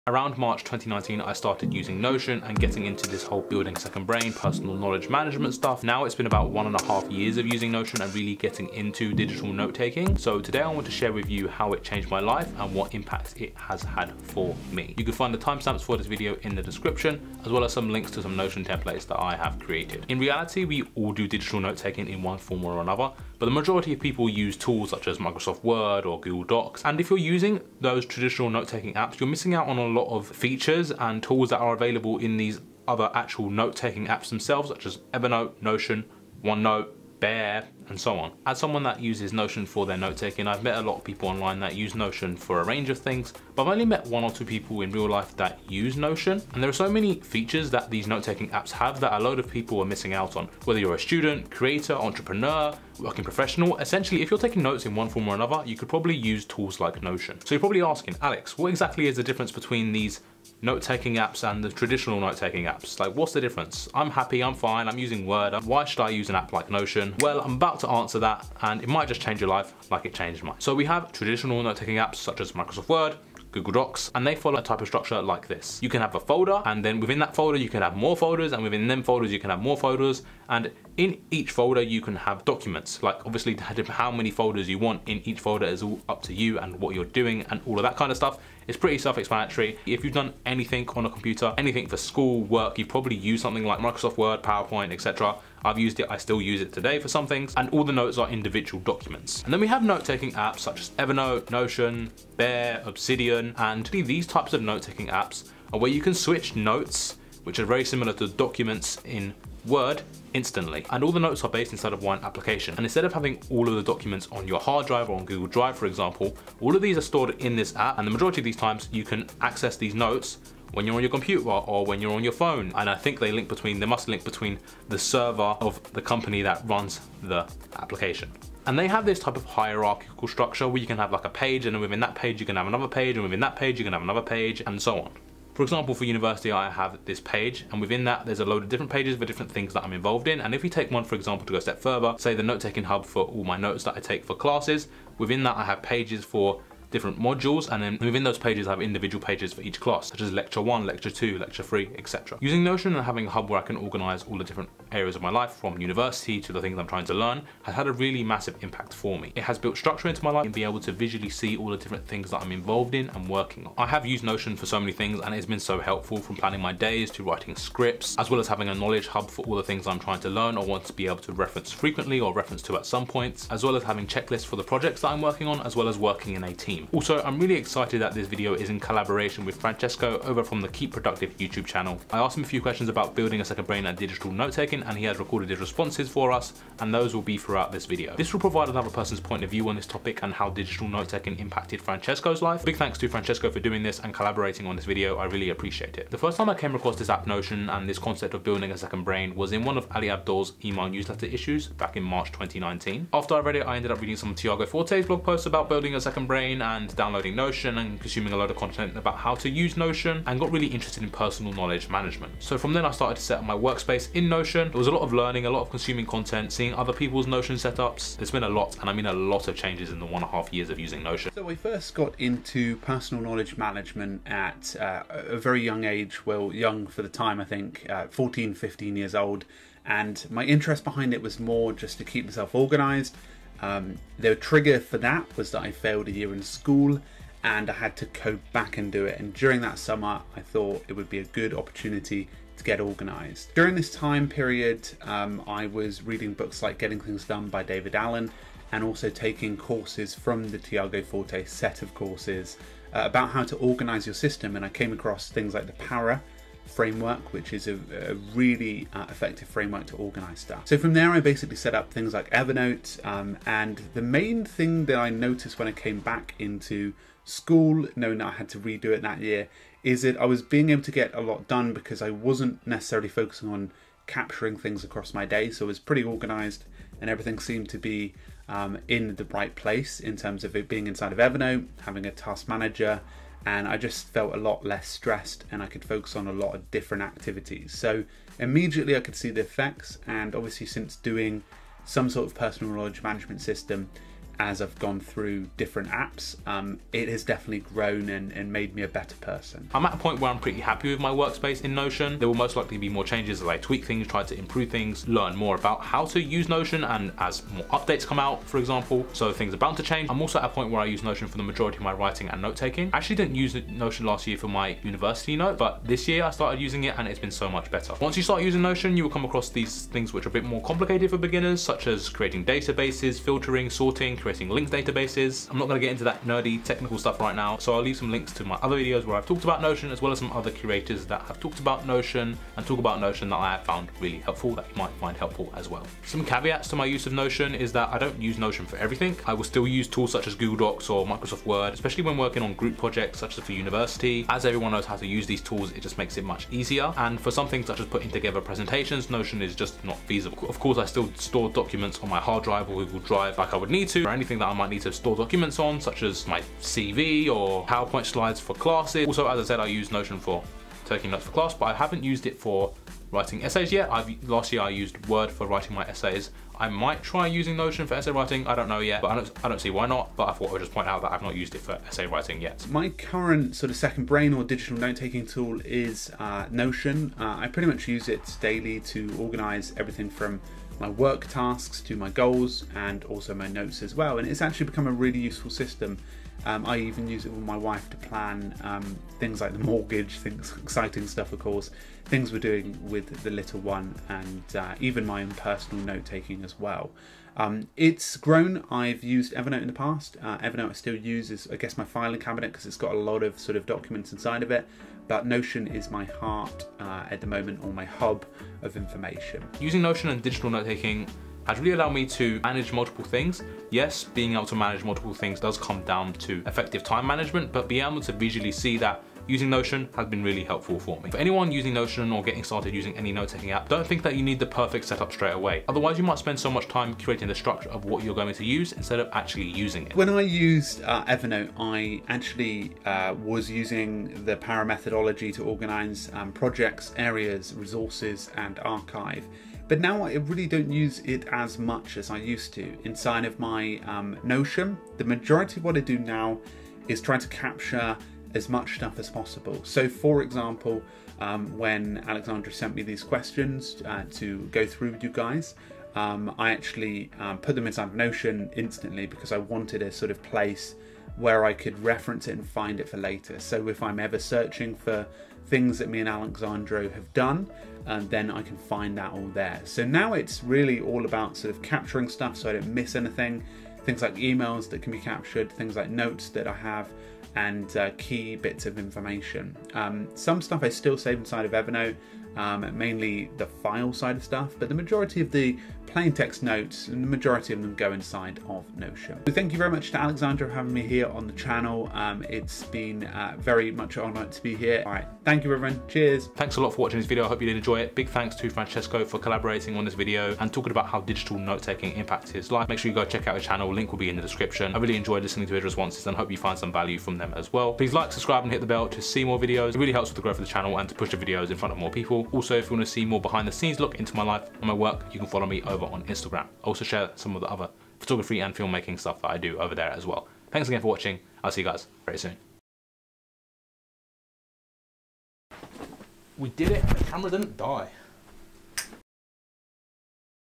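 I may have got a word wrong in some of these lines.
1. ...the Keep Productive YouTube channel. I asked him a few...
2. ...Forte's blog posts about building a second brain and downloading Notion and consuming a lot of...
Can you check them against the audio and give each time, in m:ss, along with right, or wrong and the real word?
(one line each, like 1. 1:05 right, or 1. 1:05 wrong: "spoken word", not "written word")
1. 3:00 right
2. 3:24 right.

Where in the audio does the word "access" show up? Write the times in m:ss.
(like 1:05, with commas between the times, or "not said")
1:59.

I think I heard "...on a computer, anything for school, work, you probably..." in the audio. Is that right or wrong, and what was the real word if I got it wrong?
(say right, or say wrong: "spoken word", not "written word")
right.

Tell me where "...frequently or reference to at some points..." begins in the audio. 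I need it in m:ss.
2:51.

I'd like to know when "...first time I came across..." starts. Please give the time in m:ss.
3:16.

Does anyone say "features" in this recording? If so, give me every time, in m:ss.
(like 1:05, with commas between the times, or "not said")
0:30, 0:47.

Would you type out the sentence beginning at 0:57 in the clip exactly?
So you're probably asking, Alex, what exactly is the difference between these note-taking apps and the traditional note-taking apps.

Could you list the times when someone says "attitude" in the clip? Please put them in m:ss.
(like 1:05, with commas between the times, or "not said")
not said.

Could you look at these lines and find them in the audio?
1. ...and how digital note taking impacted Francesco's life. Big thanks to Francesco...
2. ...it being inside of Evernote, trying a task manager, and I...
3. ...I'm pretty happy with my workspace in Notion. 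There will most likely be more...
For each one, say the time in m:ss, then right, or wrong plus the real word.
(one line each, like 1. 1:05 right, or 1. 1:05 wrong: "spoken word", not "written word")
1. 3:10 right
2. 4:40 wrong: "having", not "trying"
3. 5:00 right.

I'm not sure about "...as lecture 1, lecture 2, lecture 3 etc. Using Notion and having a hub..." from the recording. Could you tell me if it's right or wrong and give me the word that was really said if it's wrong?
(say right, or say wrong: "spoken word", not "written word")
right.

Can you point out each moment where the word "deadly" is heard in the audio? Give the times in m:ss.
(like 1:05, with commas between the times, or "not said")
not said.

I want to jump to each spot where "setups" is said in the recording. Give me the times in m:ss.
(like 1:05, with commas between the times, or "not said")
3:37, 7:04.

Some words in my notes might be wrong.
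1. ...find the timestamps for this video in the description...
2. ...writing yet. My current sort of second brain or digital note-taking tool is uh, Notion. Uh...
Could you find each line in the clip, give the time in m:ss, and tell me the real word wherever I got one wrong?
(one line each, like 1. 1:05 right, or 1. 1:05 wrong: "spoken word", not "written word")
1. 0:15 right
2. 6:12 right.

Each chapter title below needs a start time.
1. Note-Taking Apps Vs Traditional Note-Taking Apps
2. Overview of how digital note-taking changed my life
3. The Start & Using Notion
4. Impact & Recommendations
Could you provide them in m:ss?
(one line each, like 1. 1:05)
1. 0:20
2. 2:32
3. 3:16
4. 6:49.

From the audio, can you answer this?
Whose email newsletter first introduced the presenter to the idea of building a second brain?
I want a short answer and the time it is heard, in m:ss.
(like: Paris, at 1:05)
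Ali Abdaal, at 3:19.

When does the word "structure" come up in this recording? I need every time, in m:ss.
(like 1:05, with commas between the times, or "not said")
1:14, 2:10, 2:39, 7:07.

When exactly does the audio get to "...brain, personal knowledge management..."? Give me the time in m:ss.
0:04.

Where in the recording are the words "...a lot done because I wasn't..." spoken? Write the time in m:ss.
4:31.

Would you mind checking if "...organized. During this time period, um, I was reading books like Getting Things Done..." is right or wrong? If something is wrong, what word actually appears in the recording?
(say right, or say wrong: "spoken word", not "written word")
right.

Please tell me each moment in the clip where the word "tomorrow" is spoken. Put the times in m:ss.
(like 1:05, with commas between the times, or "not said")
not said.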